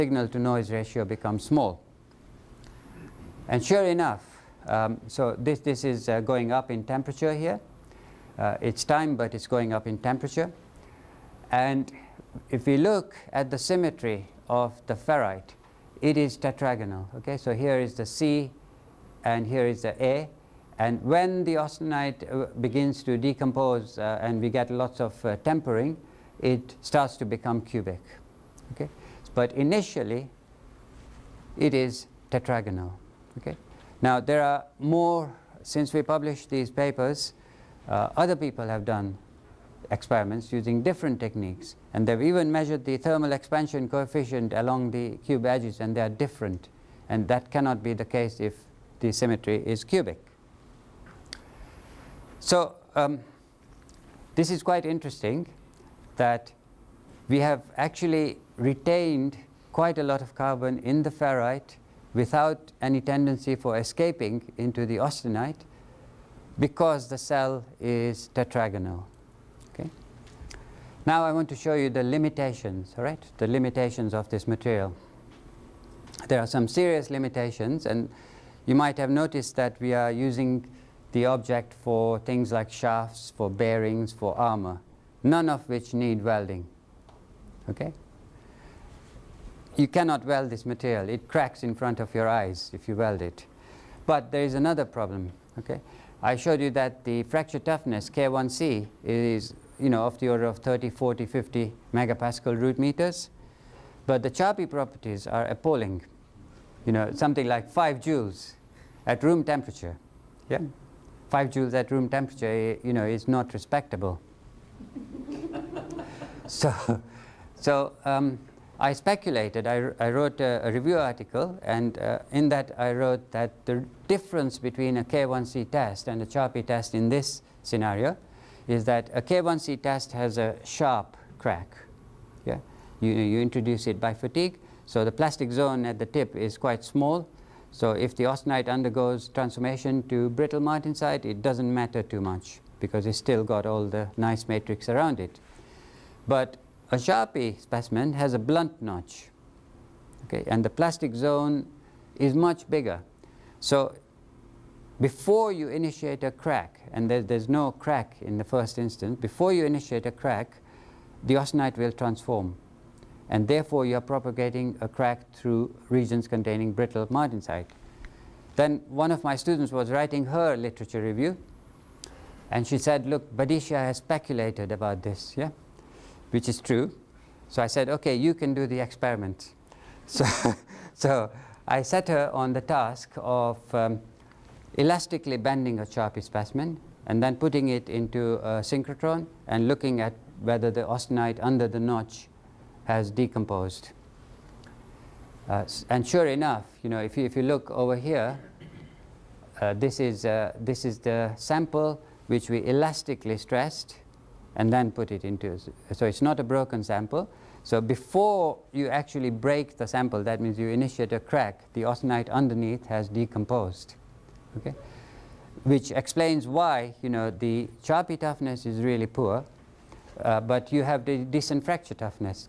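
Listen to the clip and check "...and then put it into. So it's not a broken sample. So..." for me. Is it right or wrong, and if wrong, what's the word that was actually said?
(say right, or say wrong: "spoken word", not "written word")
right.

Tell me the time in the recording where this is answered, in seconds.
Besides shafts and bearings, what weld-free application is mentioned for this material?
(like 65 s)
84 s.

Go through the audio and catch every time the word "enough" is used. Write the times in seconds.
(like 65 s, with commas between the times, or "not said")
3 s, 196 s.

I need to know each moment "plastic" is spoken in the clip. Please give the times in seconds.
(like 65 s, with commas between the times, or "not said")
135 s, 150 s.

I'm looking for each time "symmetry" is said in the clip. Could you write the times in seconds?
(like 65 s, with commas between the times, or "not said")
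13 s, 49 s.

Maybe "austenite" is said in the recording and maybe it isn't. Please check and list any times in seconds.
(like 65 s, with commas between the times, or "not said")
21 s, 64 s, 138 s, 161 s, 190 s, 211 s.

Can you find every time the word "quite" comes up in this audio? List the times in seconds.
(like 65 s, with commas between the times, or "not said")
54 s, 59 s, 136 s.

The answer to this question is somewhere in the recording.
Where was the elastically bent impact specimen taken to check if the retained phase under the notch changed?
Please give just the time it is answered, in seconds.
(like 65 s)
188 s.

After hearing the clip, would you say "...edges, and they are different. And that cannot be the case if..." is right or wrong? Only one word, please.
right.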